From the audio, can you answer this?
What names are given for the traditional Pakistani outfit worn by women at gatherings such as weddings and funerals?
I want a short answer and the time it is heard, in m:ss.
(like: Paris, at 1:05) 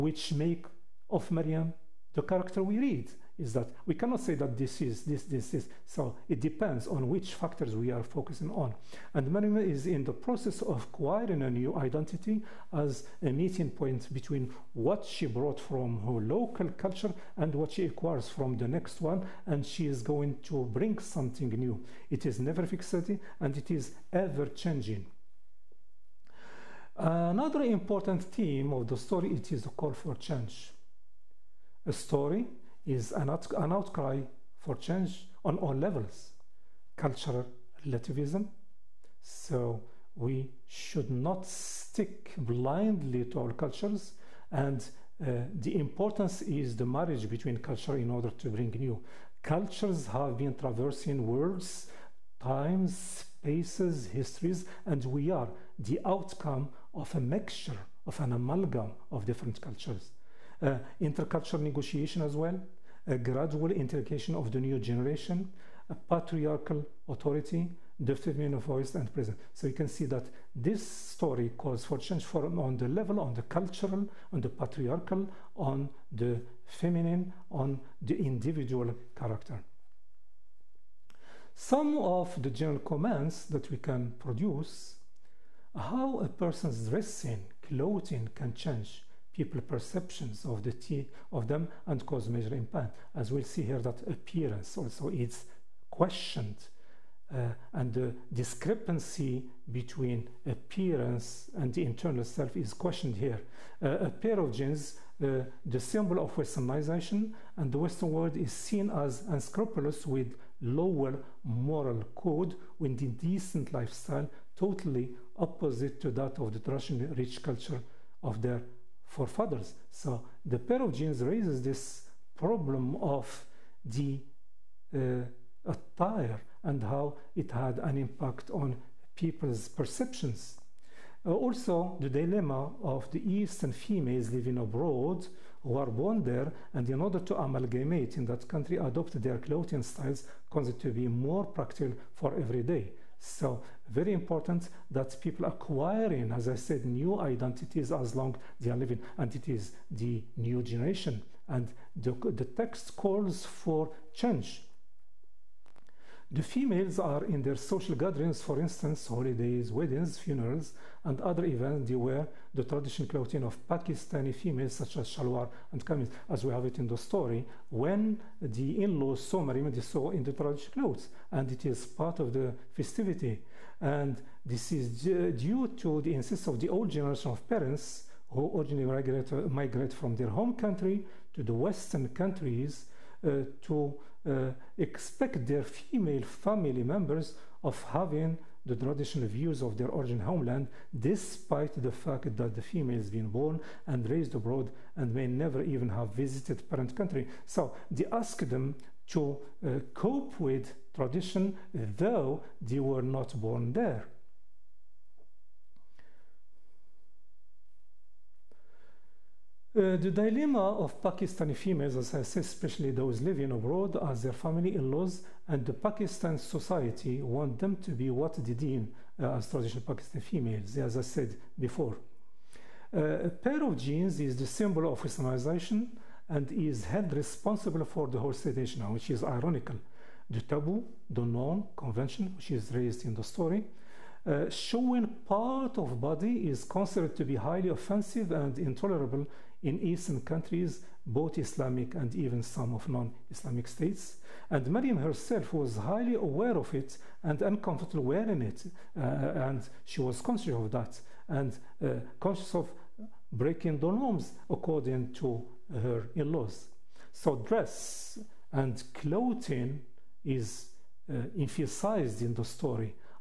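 shalwar and kameez, at 2:45.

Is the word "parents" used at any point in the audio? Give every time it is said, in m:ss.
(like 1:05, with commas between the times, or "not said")
2:57, 3:16.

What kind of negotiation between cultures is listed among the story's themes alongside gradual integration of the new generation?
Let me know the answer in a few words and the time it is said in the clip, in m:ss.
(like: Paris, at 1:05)
intercultural negotiation, at 1:01.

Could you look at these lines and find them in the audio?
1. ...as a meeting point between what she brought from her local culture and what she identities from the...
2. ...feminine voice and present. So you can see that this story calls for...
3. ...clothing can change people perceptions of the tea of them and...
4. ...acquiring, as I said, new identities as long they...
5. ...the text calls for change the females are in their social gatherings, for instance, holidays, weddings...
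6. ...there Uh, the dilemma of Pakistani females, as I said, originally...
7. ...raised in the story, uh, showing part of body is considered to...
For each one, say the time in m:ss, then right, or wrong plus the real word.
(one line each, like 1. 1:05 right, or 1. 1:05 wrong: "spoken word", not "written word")
1. 0:12 wrong: "acquires", not "identities"
2. 1:08 right
3. 1:27 right
4. 2:25 right
5. 2:32 right
6. 3:23 wrong: "especially", not "originally"
7. 3:52 right.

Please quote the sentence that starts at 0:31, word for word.
A story is an, out an outcry for change on all levels cultural relativism.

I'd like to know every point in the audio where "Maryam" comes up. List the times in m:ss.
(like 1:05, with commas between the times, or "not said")
2:49, 4:04.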